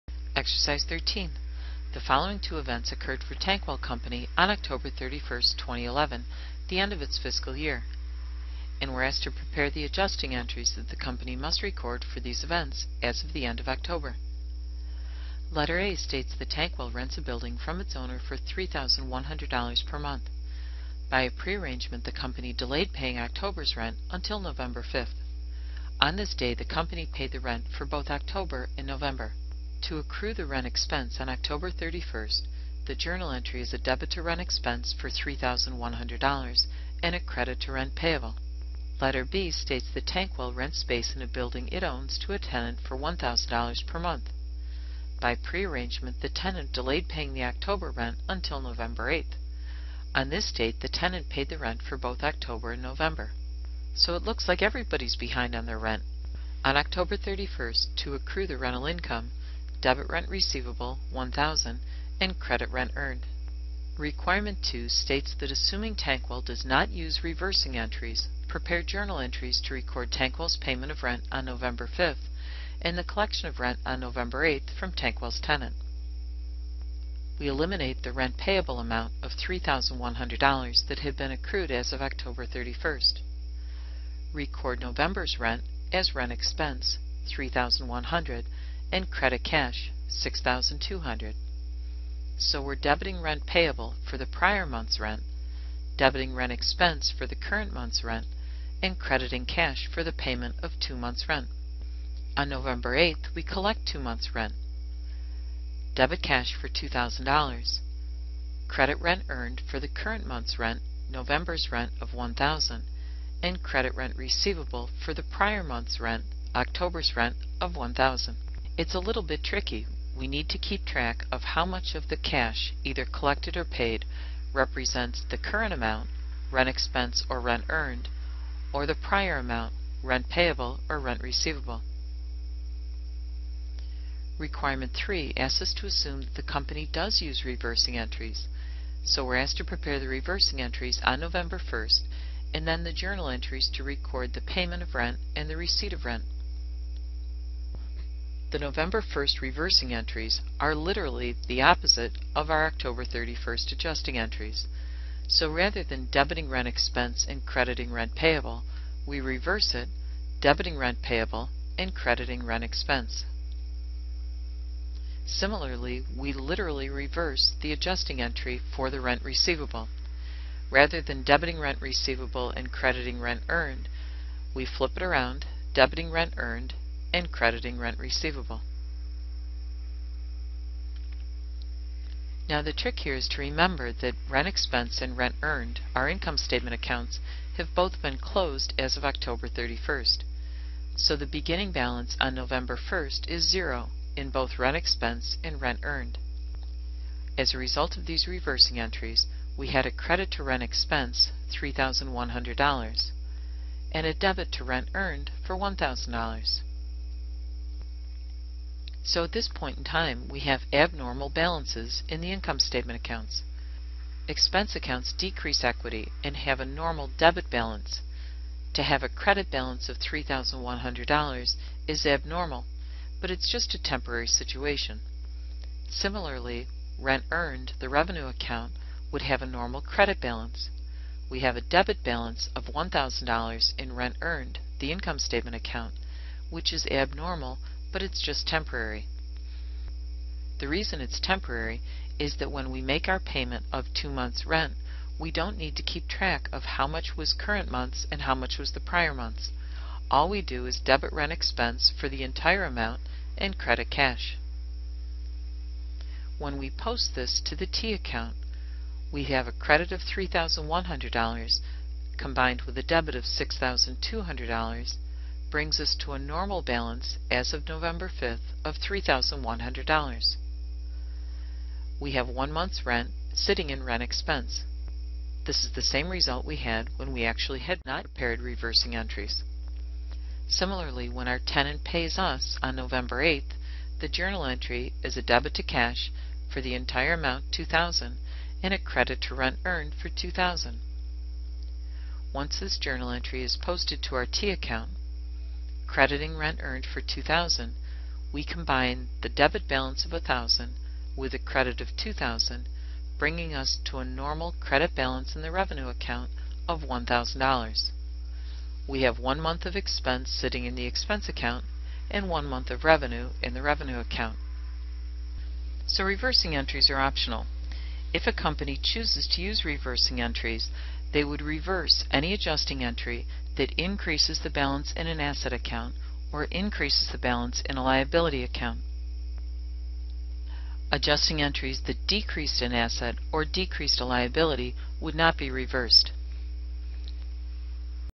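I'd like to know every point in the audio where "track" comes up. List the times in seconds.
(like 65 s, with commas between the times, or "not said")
120 s, 246 s.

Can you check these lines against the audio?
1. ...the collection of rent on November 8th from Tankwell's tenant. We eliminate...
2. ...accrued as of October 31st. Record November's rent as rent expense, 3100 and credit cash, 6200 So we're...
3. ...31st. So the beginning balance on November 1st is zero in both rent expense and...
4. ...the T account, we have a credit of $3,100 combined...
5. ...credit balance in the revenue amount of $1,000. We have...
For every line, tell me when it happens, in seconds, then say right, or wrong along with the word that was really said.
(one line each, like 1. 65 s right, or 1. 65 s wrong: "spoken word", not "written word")
1. 72 s right
2. 81 s right
3. 189 s right
4. 257 s right
5. 304 s wrong: "account", not "amount".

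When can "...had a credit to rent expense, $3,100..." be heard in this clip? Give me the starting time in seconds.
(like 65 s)
199 s.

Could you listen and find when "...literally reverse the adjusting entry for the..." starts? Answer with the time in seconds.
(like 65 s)
166 s.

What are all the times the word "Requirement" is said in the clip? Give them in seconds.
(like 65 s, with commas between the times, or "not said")
63 s, 134 s.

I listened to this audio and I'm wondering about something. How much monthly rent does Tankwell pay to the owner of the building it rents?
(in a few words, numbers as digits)
$3,100.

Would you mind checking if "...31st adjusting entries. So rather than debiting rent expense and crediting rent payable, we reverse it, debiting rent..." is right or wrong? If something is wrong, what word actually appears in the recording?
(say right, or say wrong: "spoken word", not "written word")
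right.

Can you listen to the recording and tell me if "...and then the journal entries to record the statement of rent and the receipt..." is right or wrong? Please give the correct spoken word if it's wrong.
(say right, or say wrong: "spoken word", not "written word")
wrong: "payment", not "statement".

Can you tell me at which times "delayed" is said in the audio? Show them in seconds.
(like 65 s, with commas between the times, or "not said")
22 s, 46 s.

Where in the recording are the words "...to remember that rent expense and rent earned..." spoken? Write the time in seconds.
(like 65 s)
183 s.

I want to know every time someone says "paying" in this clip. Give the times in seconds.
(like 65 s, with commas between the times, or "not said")
22 s, 47 s.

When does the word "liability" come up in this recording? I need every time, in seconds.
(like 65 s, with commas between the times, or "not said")
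327 s, 334 s.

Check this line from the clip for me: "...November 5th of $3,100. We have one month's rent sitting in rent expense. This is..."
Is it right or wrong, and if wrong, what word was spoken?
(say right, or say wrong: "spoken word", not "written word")
right.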